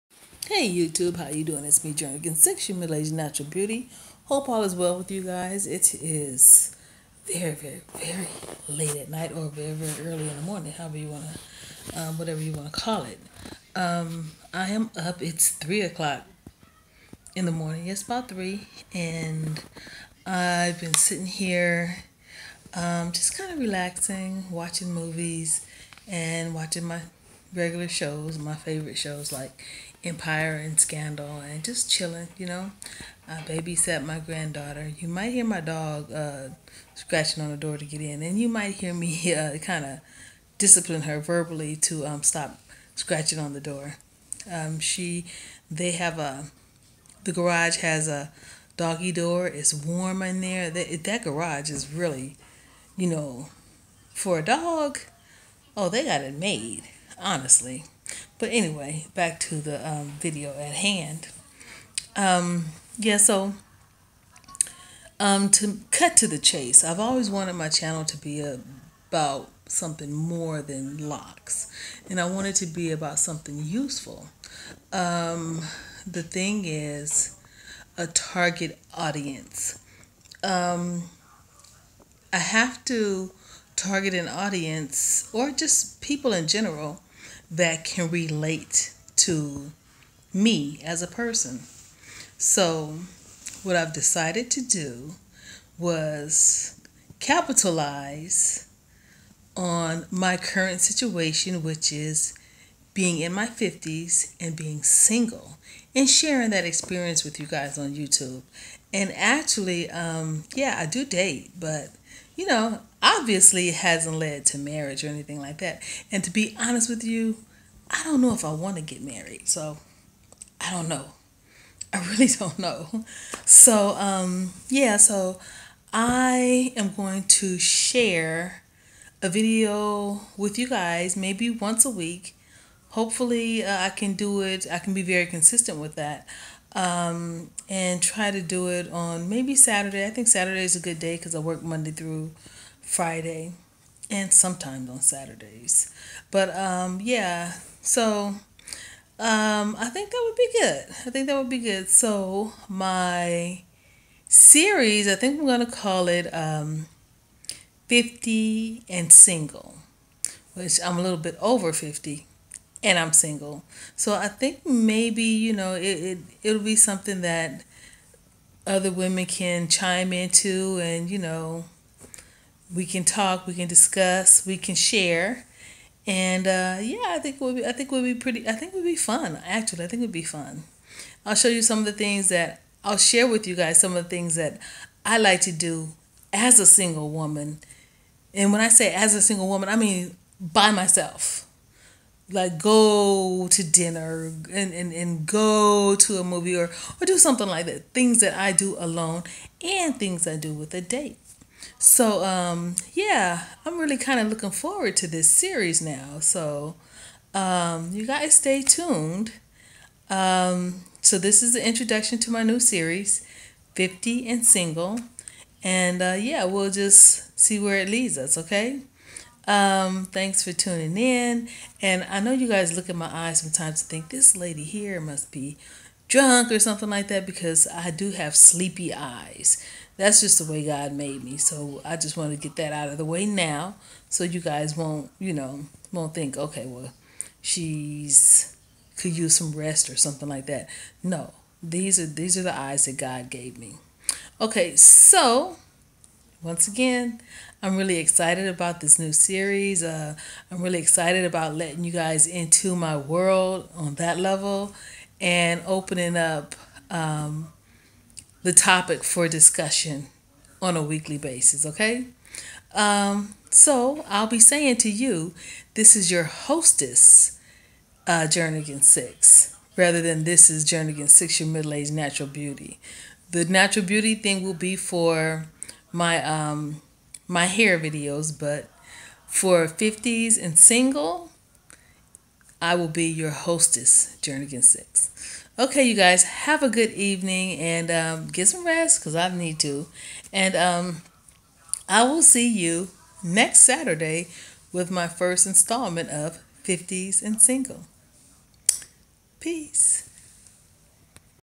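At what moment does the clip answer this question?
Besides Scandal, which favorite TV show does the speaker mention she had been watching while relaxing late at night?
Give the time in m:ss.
0:30.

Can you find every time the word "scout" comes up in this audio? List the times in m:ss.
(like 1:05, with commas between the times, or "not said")
not said.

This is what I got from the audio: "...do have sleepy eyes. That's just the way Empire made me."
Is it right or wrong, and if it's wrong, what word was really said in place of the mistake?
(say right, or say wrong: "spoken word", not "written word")
wrong: "God", not "Empire".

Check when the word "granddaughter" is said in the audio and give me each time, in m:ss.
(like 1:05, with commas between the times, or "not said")
0:34.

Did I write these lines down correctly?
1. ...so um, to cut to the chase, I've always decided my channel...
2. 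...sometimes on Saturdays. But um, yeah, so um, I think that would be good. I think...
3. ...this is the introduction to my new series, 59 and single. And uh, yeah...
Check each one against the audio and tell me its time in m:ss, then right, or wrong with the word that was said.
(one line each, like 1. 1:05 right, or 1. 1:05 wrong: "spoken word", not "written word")
1. 1:03 wrong: "wanted", not "decided"
2. 2:24 right
3. 3:31 wrong: "50", not "59".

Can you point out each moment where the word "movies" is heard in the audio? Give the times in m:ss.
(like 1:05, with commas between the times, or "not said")
0:24, 3:16.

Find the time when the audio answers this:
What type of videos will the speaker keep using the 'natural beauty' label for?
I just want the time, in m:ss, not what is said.
4:37.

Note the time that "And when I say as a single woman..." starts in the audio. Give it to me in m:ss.
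3:08.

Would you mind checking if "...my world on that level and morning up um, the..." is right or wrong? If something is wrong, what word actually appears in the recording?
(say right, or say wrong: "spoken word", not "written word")
wrong: "opening", not "morning".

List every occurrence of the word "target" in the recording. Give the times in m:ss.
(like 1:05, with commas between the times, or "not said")
1:18, 1:23.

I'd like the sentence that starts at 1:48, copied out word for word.
And actually, um, yeah, I do date, but you know, obviously it hasn't led to marriage or anything like that.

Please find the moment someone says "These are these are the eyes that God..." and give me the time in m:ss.
4:01.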